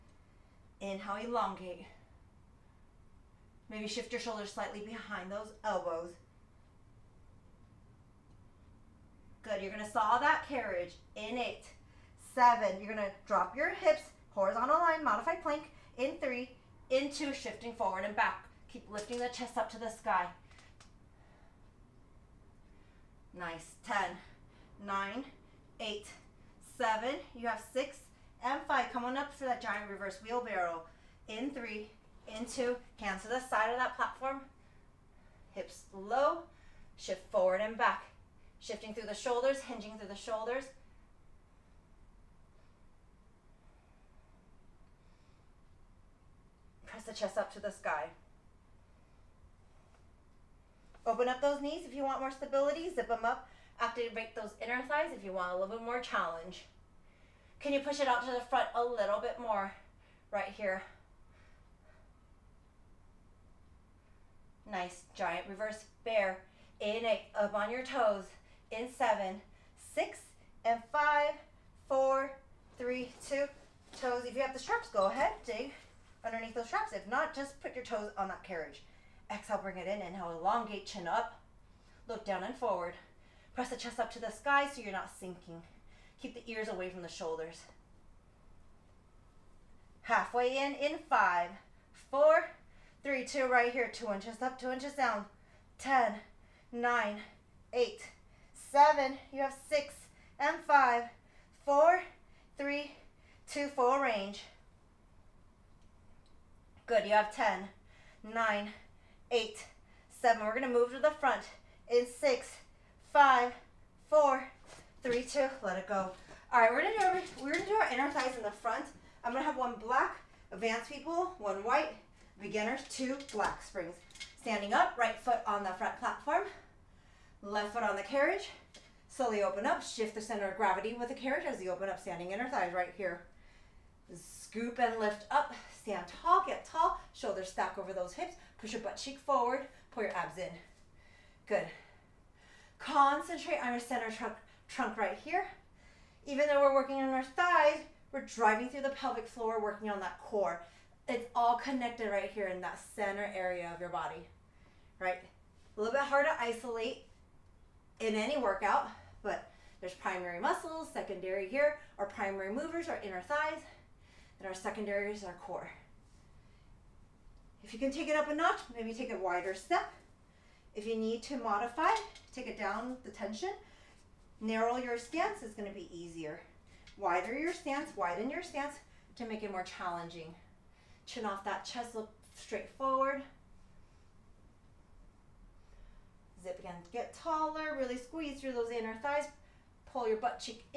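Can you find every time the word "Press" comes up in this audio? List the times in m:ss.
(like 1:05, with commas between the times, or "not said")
0:46, 1:23.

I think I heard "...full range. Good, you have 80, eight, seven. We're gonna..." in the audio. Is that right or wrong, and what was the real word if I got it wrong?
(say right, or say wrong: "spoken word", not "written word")
wrong: "10", not "80".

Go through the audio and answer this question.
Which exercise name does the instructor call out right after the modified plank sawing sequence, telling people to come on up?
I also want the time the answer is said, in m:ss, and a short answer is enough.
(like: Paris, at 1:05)
Giant reverse wheelbarrow, at 0:29.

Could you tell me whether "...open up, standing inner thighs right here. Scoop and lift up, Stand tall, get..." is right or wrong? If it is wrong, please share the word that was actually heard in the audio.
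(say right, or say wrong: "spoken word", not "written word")
right.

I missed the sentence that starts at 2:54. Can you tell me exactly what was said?
Narrow your stance is gonna be easier.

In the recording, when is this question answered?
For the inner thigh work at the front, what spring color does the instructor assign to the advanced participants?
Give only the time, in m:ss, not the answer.
1:59.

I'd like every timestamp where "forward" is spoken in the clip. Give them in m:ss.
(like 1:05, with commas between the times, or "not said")
0:17, 0:37, 1:22, 2:19, 3:02.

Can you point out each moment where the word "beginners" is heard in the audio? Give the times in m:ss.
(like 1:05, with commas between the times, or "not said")
2:02.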